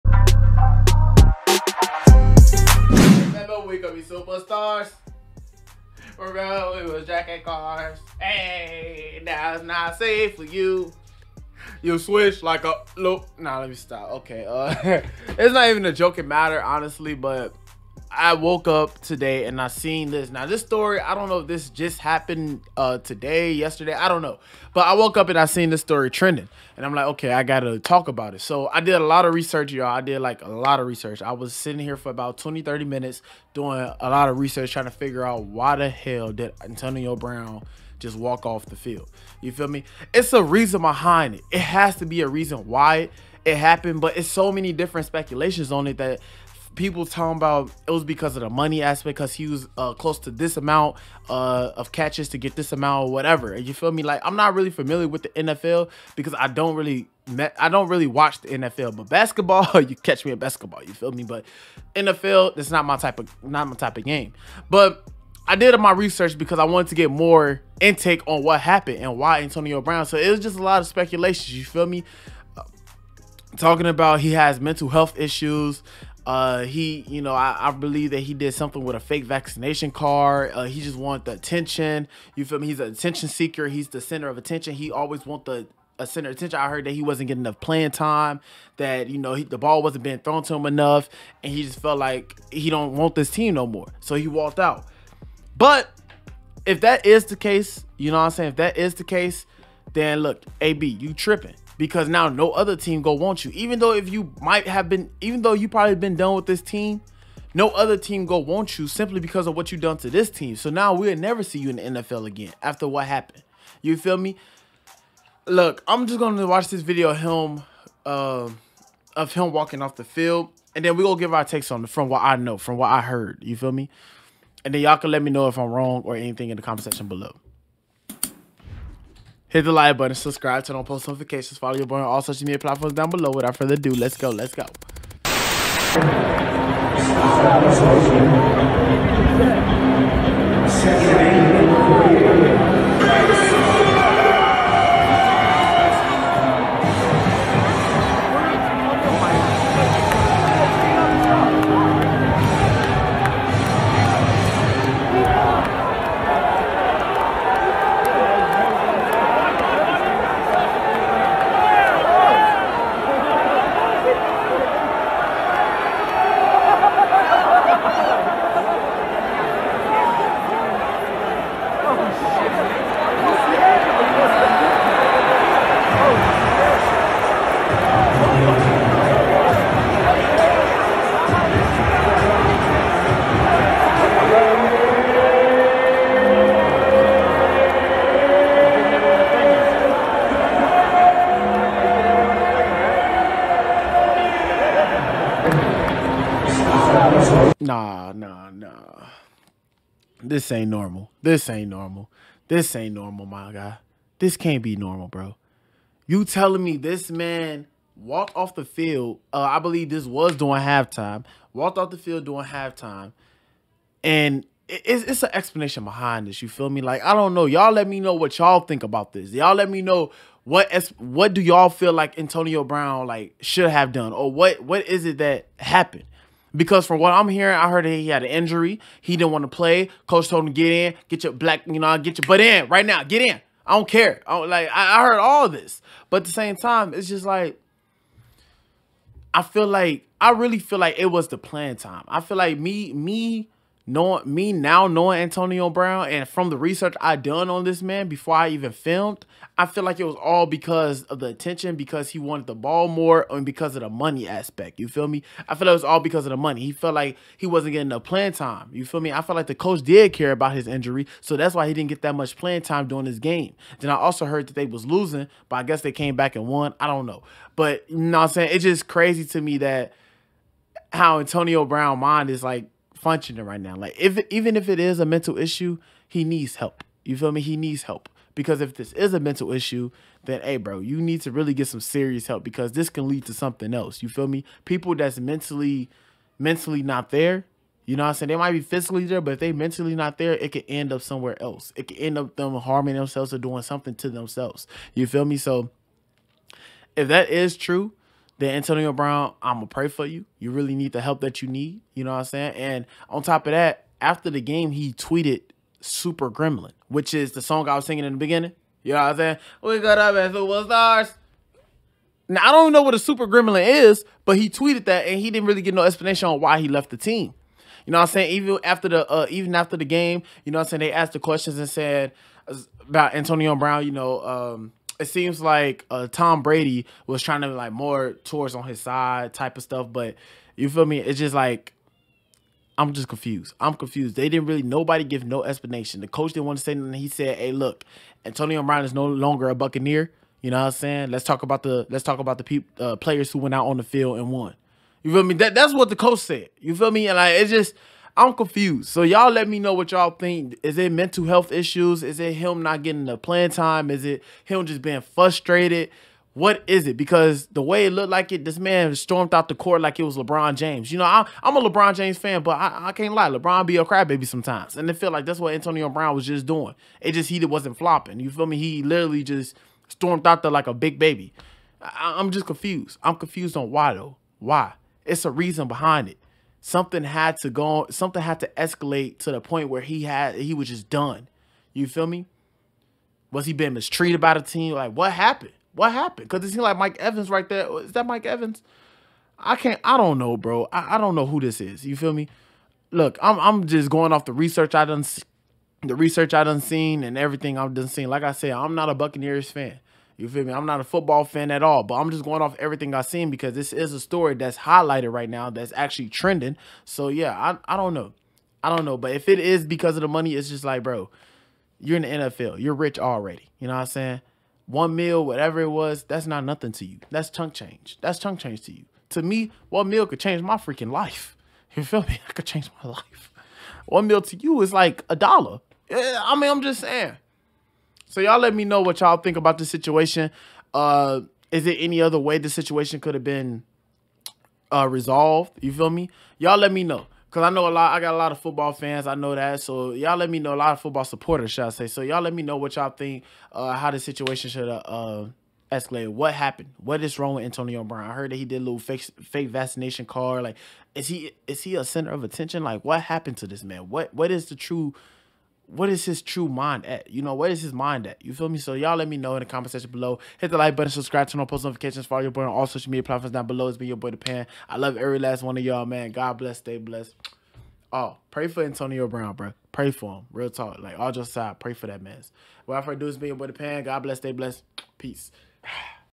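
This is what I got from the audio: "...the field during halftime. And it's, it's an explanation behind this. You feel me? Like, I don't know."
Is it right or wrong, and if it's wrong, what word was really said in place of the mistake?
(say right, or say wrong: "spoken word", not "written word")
right.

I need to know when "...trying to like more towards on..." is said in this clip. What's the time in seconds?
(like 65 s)
327 s.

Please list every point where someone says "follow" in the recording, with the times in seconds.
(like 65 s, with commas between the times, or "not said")
131 s, 462 s.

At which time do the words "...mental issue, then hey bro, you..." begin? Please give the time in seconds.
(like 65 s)
279 s.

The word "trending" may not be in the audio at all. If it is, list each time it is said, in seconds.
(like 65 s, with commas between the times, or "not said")
26 s, 406 s.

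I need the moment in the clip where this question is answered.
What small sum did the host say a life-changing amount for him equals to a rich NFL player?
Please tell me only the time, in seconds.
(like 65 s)
425 s.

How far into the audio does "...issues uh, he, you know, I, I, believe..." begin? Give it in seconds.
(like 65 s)
75 s.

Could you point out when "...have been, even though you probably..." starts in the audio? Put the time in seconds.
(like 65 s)
104 s.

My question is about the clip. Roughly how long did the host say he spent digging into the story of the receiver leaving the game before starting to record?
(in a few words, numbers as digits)
20 to 30 minutes.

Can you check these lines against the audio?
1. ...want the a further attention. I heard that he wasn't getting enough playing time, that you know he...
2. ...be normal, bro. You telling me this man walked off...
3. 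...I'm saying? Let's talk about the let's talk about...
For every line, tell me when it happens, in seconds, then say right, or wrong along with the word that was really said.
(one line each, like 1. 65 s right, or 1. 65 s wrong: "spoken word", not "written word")
1. 85 s wrong: "center", not "further"
2. 204 s right
3. 340 s right.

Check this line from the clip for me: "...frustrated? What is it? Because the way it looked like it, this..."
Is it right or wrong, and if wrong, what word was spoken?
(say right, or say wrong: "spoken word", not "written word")
right.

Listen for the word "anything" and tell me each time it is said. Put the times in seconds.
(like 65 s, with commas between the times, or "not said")
126 s, 336 s.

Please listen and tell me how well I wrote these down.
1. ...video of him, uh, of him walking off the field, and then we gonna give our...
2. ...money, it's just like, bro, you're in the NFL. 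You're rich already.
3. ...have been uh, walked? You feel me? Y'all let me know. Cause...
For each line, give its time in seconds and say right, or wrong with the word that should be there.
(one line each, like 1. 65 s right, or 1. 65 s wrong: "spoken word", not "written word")
1. 116 s right
2. 410 s right
3. 433 s wrong: "resolved", not "walked".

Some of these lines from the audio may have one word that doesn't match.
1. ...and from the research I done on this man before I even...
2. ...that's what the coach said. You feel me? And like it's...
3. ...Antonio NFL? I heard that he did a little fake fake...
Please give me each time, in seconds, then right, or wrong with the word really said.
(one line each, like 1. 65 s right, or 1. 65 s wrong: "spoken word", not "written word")
1. 246 s right
2. 345 s right
3. 447 s wrong: "Brown", not "NFL".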